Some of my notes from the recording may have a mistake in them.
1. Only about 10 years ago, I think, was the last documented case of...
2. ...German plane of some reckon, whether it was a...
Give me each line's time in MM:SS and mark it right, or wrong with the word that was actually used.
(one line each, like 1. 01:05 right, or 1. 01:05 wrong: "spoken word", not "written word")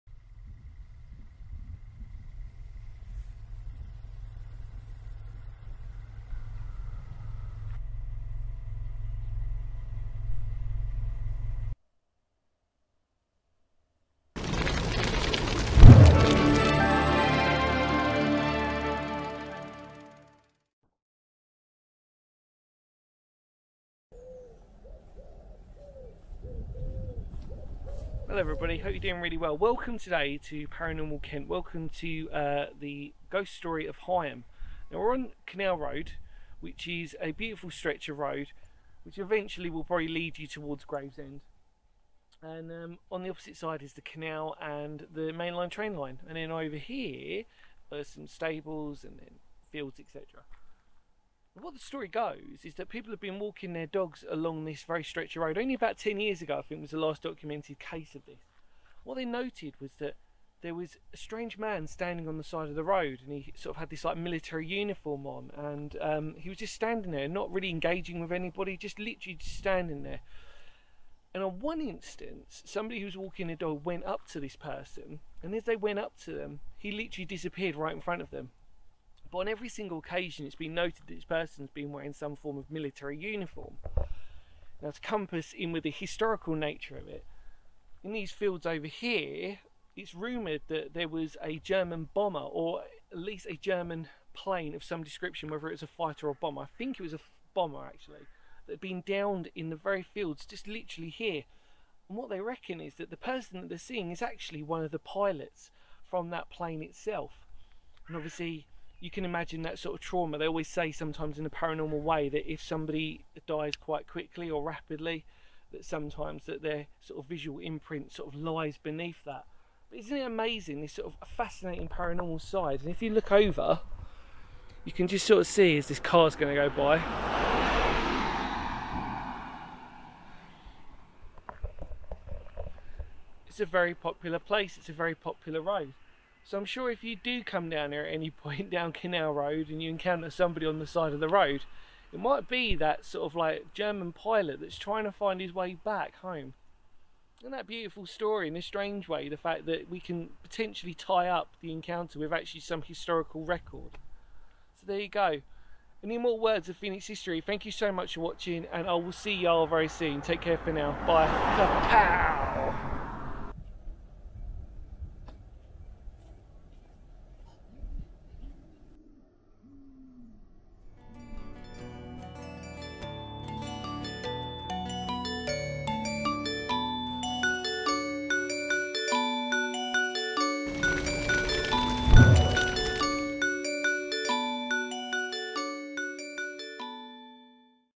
1. 00:55 right
2. 01:33 wrong: "description", not "reckon".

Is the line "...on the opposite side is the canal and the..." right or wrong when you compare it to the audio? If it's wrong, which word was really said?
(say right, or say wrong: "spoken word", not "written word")
right.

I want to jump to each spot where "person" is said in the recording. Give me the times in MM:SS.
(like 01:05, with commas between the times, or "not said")
01:14, 01:21, 01:43.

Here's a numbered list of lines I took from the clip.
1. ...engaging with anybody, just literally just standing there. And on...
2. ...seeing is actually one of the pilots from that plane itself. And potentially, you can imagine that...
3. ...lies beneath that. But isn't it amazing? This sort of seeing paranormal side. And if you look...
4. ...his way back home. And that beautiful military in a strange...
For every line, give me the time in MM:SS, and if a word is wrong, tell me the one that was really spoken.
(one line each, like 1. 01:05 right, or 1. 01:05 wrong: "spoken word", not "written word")
1. 01:07 right
2. 01:43 wrong: "obviously", not "potentially"
3. 01:58 wrong: "fascinating", not "seeing"
4. 02:25 wrong: "story", not "military".